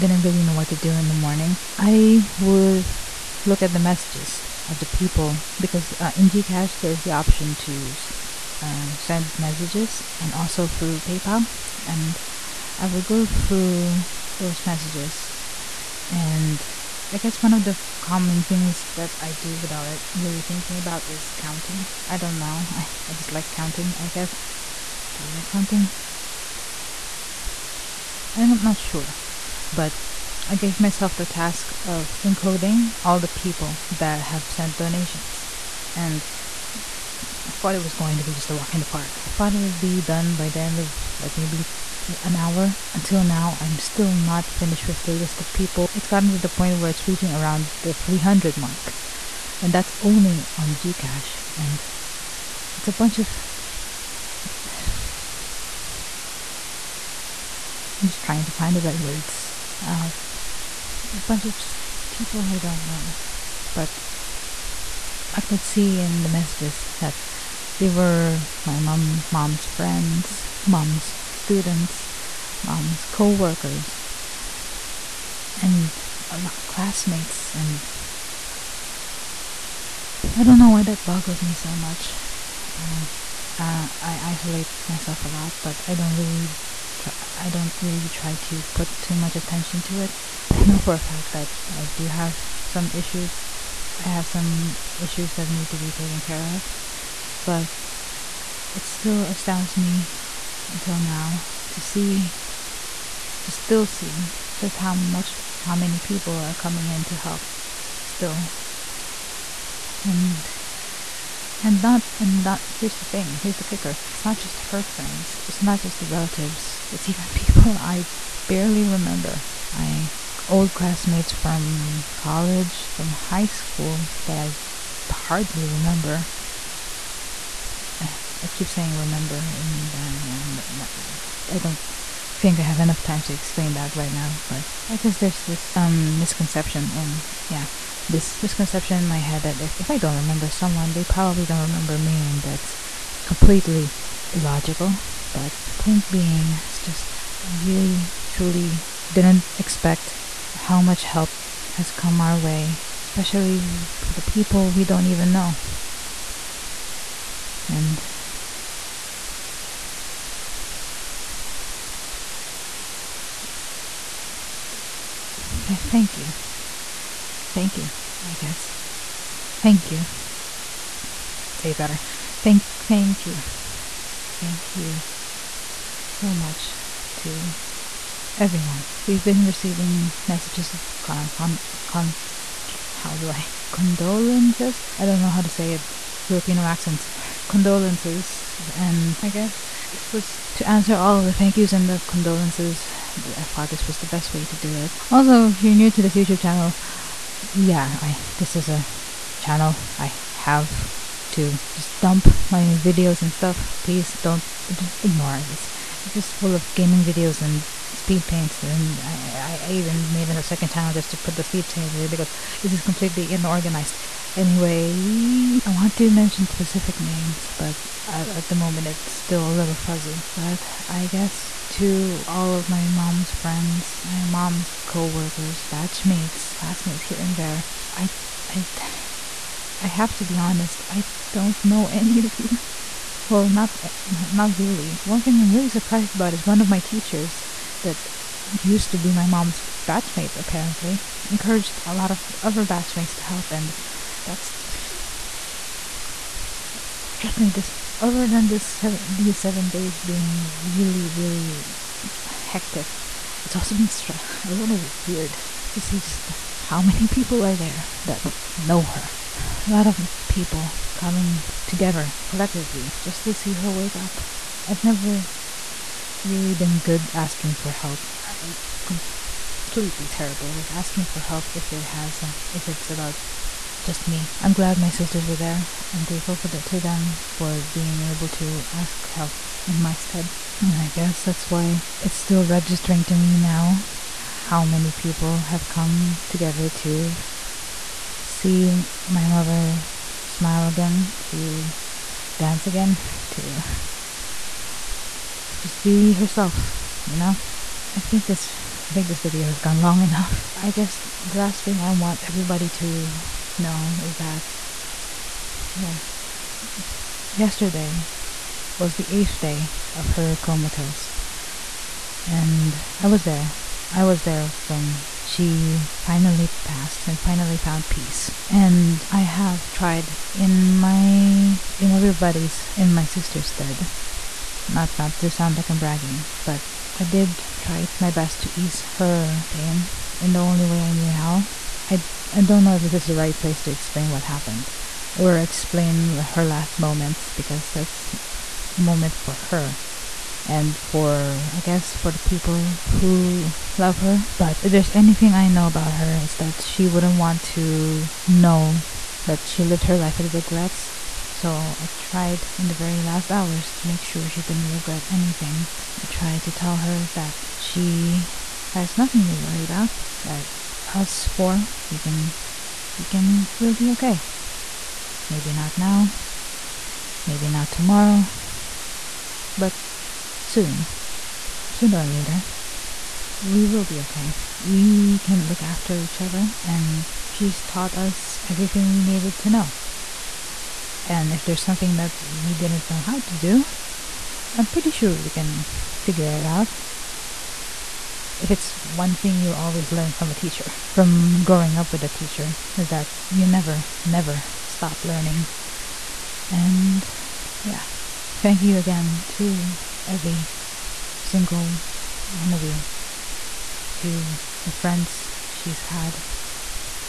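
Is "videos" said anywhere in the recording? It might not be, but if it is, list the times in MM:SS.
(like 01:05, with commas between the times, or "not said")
03:22, 03:27, 04:59.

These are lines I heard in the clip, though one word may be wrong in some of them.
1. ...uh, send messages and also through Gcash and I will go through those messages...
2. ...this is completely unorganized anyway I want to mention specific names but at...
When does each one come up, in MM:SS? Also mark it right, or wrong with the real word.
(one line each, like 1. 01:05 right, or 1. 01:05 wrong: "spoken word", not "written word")
1. 00:08 wrong: "PayPal", not "Gcash"
2. 03:32 right.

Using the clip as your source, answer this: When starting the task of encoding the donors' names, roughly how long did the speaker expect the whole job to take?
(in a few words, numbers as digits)
1 hour.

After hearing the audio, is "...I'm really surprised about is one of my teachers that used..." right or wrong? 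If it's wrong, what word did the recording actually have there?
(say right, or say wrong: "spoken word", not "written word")
right.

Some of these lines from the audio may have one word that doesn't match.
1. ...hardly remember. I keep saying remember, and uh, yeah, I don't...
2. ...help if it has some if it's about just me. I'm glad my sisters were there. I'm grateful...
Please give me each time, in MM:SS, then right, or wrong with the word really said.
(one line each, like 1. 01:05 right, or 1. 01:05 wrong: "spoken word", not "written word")
1. 02:05 right
2. 04:31 right.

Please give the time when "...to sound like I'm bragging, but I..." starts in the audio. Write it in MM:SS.
05:25.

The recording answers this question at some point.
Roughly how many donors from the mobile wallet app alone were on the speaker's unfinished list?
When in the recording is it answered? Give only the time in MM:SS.
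00:47.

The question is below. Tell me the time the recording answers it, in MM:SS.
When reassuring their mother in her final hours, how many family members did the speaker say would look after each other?
06:01.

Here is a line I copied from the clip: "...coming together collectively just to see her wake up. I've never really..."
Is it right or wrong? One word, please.
right.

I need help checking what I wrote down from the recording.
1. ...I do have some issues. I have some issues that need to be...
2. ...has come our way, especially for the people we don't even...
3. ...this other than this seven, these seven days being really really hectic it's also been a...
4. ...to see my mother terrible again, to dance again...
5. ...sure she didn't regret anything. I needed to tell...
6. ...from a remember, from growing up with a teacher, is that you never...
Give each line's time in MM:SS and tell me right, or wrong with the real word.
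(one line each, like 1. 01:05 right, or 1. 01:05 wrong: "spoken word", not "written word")
1. 01:31 right
2. 02:31 right
3. 04:07 right
4. 04:46 wrong: "smile", not "terrible"
5. 05:54 wrong: "tried", not "needed"
6. 06:30 wrong: "teacher", not "remember".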